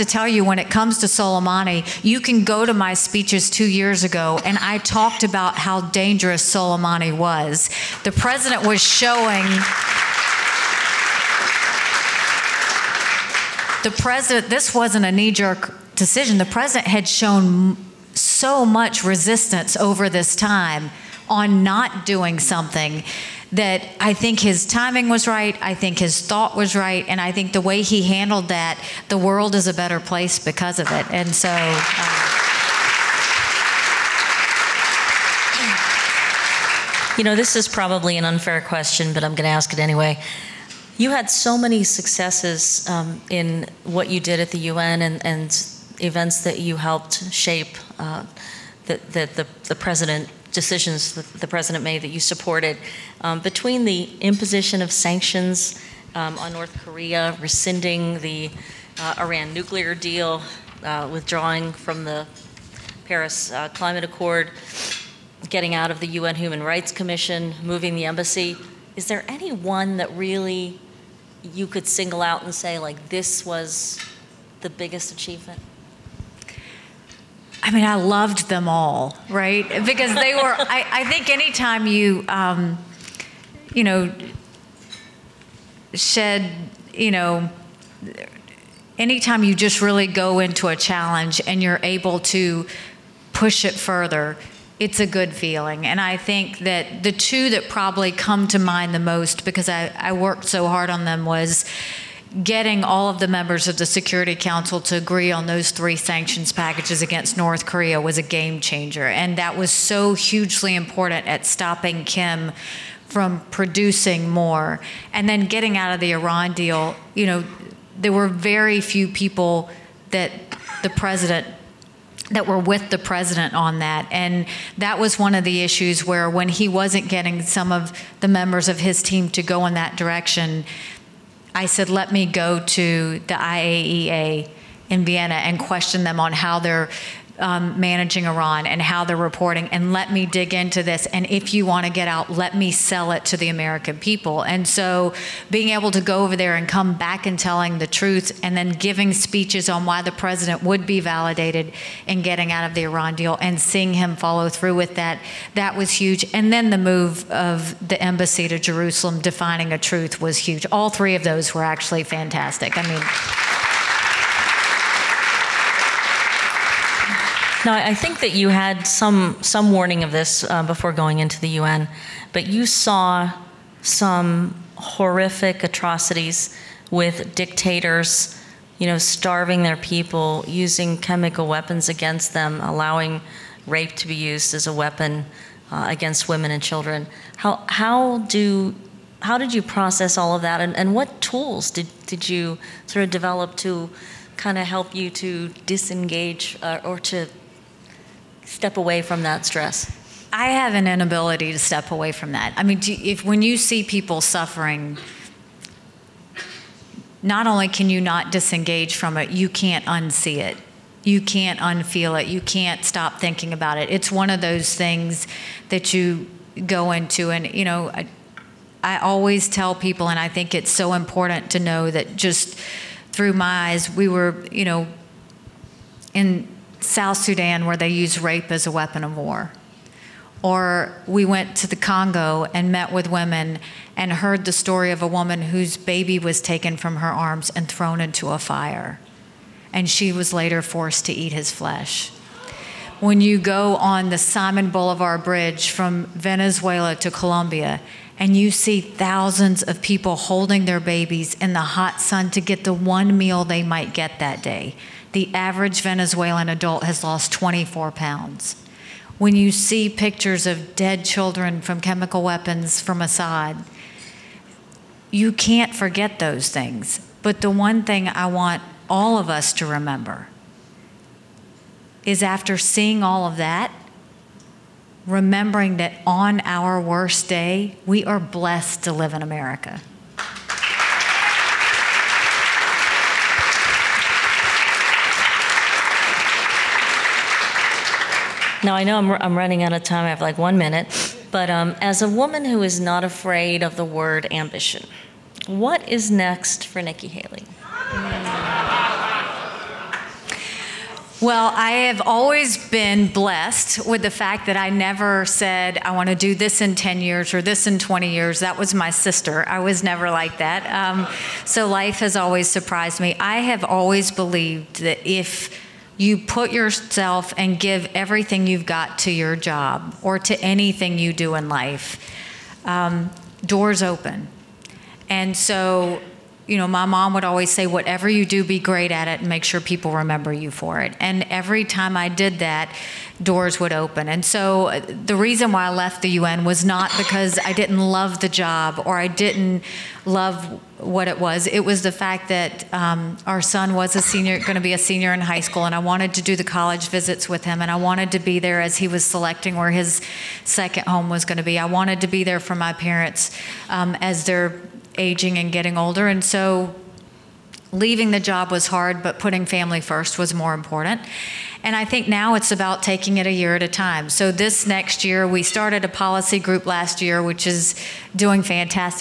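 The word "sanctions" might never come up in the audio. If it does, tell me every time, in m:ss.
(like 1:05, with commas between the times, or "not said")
0:54, 1:45.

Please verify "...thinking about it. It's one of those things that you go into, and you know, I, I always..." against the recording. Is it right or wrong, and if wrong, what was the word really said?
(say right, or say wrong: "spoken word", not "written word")
right.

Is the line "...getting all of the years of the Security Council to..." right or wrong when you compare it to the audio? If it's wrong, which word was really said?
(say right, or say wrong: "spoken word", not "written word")
wrong: "members", not "years".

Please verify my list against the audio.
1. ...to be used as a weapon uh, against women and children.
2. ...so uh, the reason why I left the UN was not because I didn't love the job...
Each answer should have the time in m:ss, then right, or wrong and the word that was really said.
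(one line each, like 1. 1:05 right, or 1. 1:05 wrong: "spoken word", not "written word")
1. 3:03 right
2. 5:34 right.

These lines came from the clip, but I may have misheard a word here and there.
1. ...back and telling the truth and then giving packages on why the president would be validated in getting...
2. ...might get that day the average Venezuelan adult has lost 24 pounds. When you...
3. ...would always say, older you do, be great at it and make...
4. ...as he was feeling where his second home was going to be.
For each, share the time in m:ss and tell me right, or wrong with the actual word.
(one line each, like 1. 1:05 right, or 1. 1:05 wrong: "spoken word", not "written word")
1. 2:26 wrong: "speeches", not "packages"
2. 4:13 right
3. 5:27 wrong: "whatever", not "older"
4. 5:48 wrong: "selecting", not "feeling".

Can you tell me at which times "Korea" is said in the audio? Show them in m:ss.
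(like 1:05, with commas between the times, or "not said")
0:56, 1:47.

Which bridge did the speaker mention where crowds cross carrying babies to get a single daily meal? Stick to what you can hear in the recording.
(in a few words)
Simon Bolivar Bridge.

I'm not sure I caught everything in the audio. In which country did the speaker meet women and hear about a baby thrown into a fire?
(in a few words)
Congo.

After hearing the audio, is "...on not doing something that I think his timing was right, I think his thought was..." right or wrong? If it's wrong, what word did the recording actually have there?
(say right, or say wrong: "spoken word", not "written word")
right.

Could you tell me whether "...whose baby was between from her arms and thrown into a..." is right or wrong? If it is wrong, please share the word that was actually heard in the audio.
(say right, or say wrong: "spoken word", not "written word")
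wrong: "taken", not "between".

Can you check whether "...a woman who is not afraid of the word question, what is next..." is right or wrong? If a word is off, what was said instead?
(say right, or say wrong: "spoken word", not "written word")
wrong: "ambition", not "question".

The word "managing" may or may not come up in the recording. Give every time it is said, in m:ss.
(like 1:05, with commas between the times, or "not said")
2:17.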